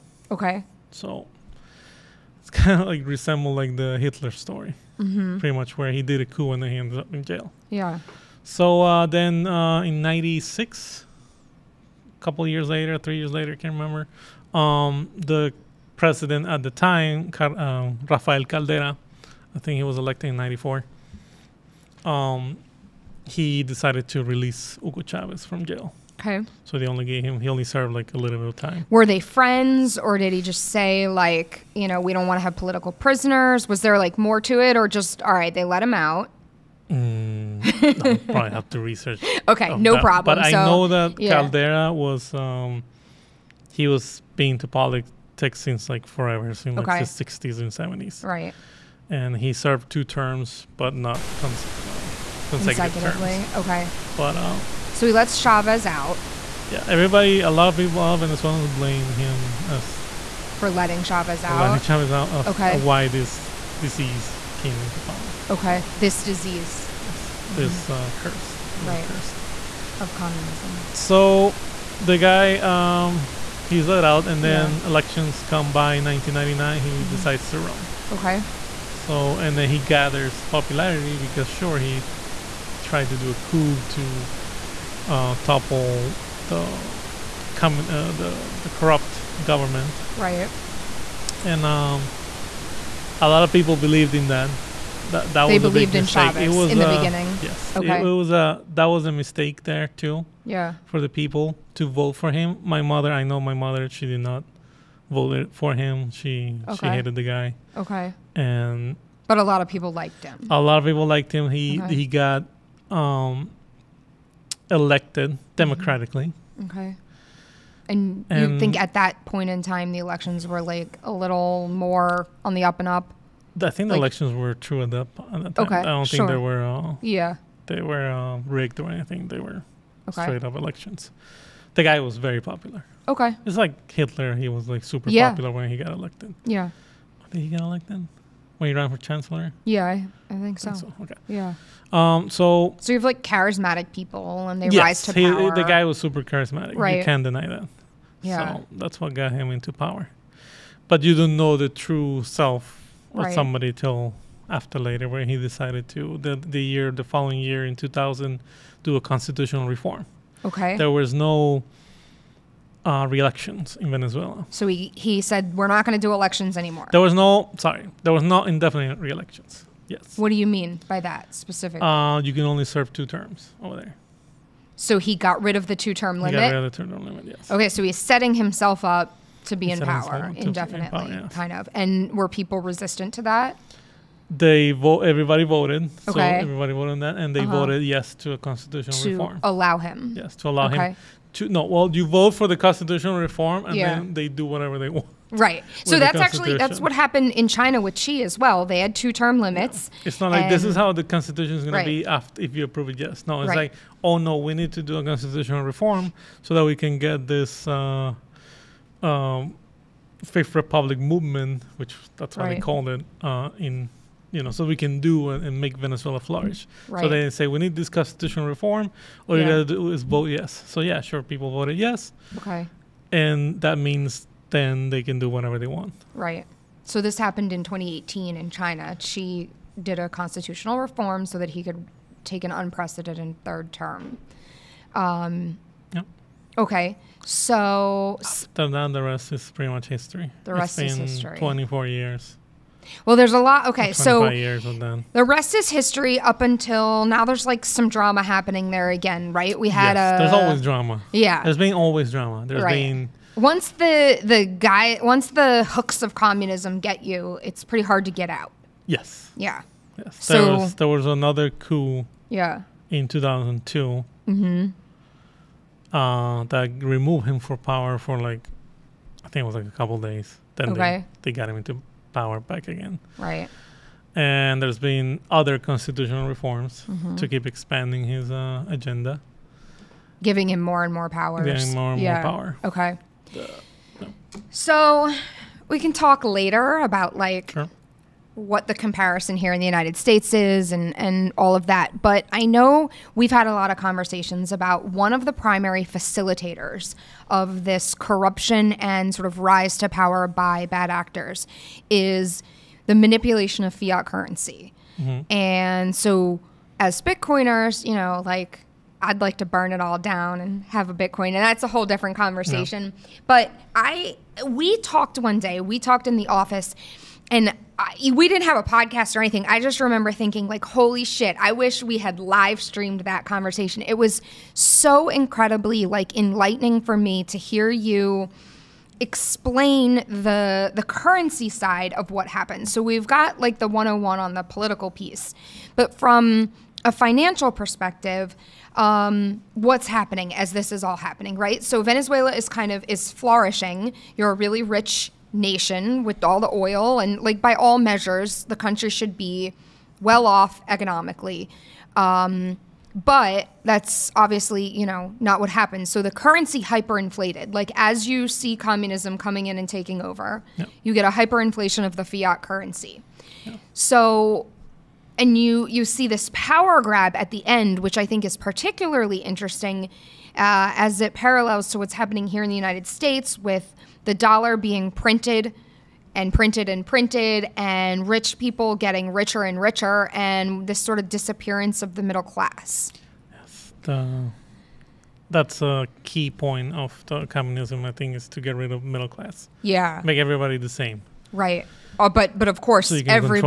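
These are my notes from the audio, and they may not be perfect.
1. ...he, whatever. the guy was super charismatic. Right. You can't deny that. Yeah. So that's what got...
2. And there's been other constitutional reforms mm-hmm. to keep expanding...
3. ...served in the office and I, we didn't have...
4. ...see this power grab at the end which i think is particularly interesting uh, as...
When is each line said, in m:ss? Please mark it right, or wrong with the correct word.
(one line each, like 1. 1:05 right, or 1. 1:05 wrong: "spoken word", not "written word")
1. 2:25 wrong: "power", not "whatever"
2. 4:34 right
3. 5:15 wrong: "talked", not "served"
4. 6:05 right.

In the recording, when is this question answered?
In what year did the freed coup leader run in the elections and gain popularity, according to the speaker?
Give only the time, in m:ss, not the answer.
1:16.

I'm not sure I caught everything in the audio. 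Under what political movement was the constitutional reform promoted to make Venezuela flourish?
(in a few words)
Fifth Republic movement.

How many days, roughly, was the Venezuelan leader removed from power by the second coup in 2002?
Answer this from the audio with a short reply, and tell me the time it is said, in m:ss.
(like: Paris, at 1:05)
a couple days, at 4:29.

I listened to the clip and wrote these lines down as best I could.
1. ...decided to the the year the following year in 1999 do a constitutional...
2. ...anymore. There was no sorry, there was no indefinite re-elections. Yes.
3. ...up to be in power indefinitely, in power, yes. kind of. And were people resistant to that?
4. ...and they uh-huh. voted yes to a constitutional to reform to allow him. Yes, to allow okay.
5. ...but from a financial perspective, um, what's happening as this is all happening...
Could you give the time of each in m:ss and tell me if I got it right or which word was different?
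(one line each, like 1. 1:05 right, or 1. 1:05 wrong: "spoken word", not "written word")
1. 2:35 wrong: "2000", not "1999"
2. 2:46 right
3. 2:58 right
4. 3:07 right
5. 5:35 right.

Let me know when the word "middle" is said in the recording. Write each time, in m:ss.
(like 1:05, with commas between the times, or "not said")
6:22, 6:28.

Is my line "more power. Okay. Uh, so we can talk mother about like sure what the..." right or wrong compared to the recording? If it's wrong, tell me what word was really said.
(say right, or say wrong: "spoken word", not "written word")
wrong: "later", not "mother".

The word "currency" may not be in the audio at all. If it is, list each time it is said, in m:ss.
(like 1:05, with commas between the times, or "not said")
5:04, 5:30, 5:56, 6:02.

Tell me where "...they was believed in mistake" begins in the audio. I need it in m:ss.
1:35.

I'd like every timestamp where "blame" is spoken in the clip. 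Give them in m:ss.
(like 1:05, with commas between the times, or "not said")
0:58.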